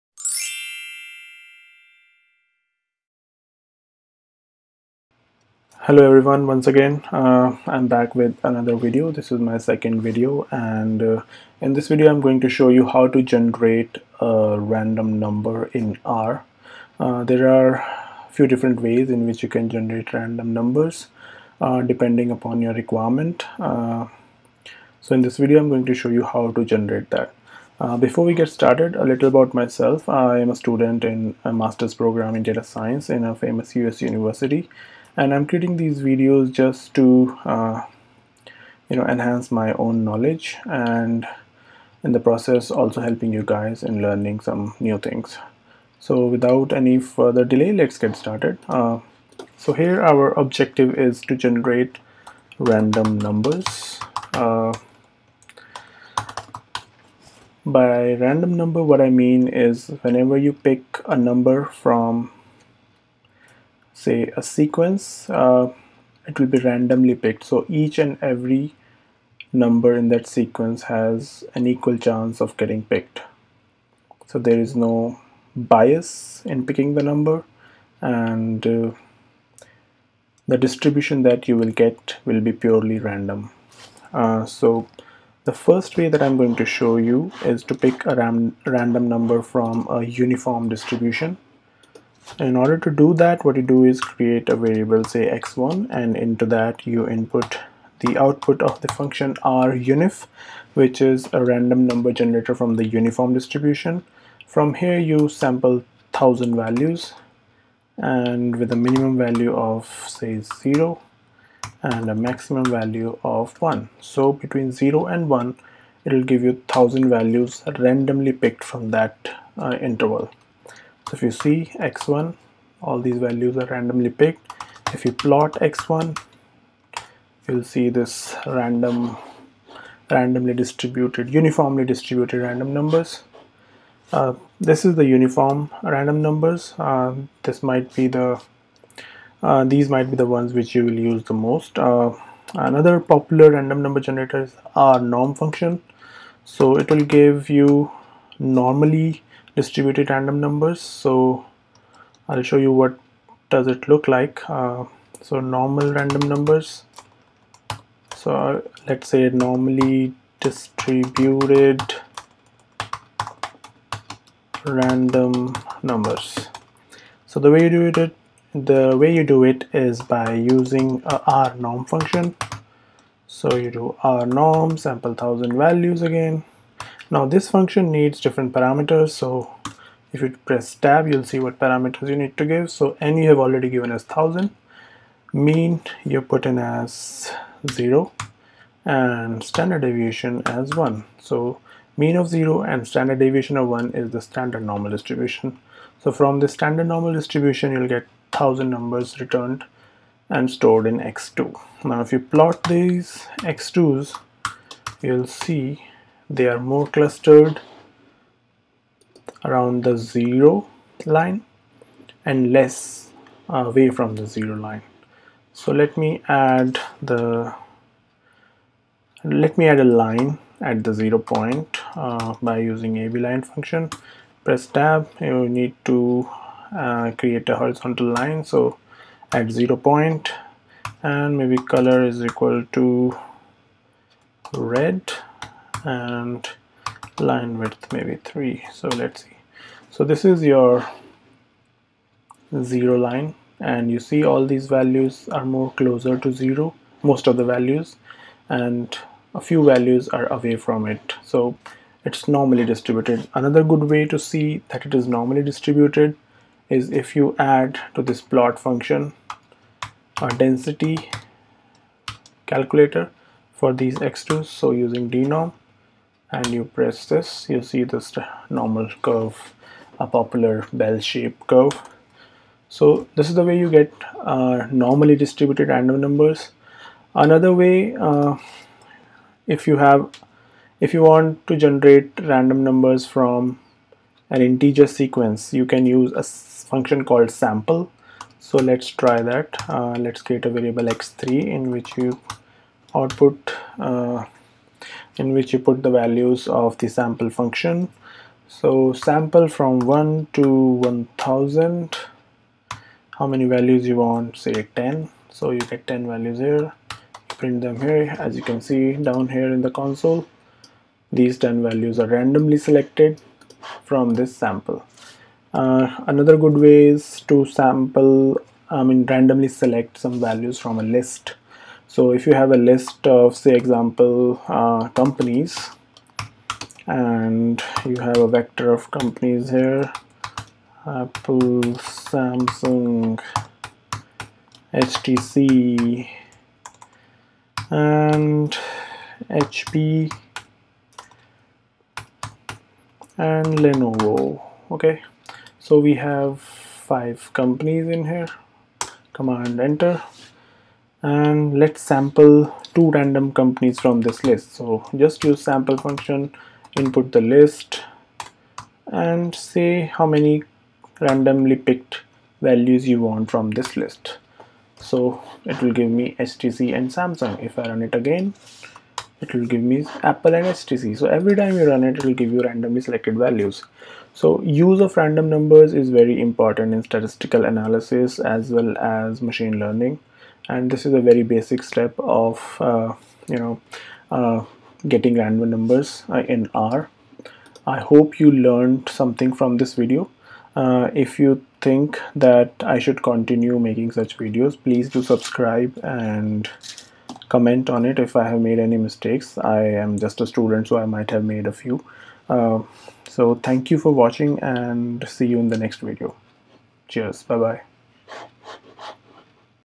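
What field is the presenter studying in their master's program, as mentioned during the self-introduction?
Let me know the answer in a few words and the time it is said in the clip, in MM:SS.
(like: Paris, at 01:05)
data science, at 00:32.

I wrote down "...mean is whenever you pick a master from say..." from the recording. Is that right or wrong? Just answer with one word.
wrong.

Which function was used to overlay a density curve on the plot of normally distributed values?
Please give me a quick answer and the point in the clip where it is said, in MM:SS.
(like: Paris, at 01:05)
dnorm, at 04:25.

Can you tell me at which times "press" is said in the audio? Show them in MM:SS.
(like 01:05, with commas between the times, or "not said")
03:00, 03:44, 04:26.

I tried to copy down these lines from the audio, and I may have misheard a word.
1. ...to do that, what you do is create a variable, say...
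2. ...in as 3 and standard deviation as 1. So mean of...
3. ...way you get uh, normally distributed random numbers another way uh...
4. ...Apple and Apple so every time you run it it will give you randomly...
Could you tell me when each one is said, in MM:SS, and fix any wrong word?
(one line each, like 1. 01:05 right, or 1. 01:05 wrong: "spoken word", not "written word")
1. 01:32 right
2. 03:06 wrong: "0", not "3"
3. 04:33 right
4. 06:10 wrong: "HTC", not "Apple".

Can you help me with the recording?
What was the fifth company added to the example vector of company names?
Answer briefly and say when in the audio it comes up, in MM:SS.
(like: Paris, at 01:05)
Lenovo, at 05:43.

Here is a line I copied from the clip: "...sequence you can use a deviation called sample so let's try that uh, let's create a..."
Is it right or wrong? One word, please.
wrong.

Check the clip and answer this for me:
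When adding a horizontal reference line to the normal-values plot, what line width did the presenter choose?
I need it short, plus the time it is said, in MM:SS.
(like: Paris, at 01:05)
3, at 03:58.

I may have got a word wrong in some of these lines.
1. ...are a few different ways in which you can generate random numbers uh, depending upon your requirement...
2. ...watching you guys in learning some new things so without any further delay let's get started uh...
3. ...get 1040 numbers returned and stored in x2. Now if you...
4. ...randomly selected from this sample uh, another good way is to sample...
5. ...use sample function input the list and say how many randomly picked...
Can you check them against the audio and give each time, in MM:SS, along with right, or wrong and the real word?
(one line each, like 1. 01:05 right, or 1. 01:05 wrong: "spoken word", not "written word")
1. 00:17 right
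2. 00:43 wrong: "helping", not "watching"
3. 03:17 wrong: "1000", not "1040"
4. 05:12 right
5. 05:55 right.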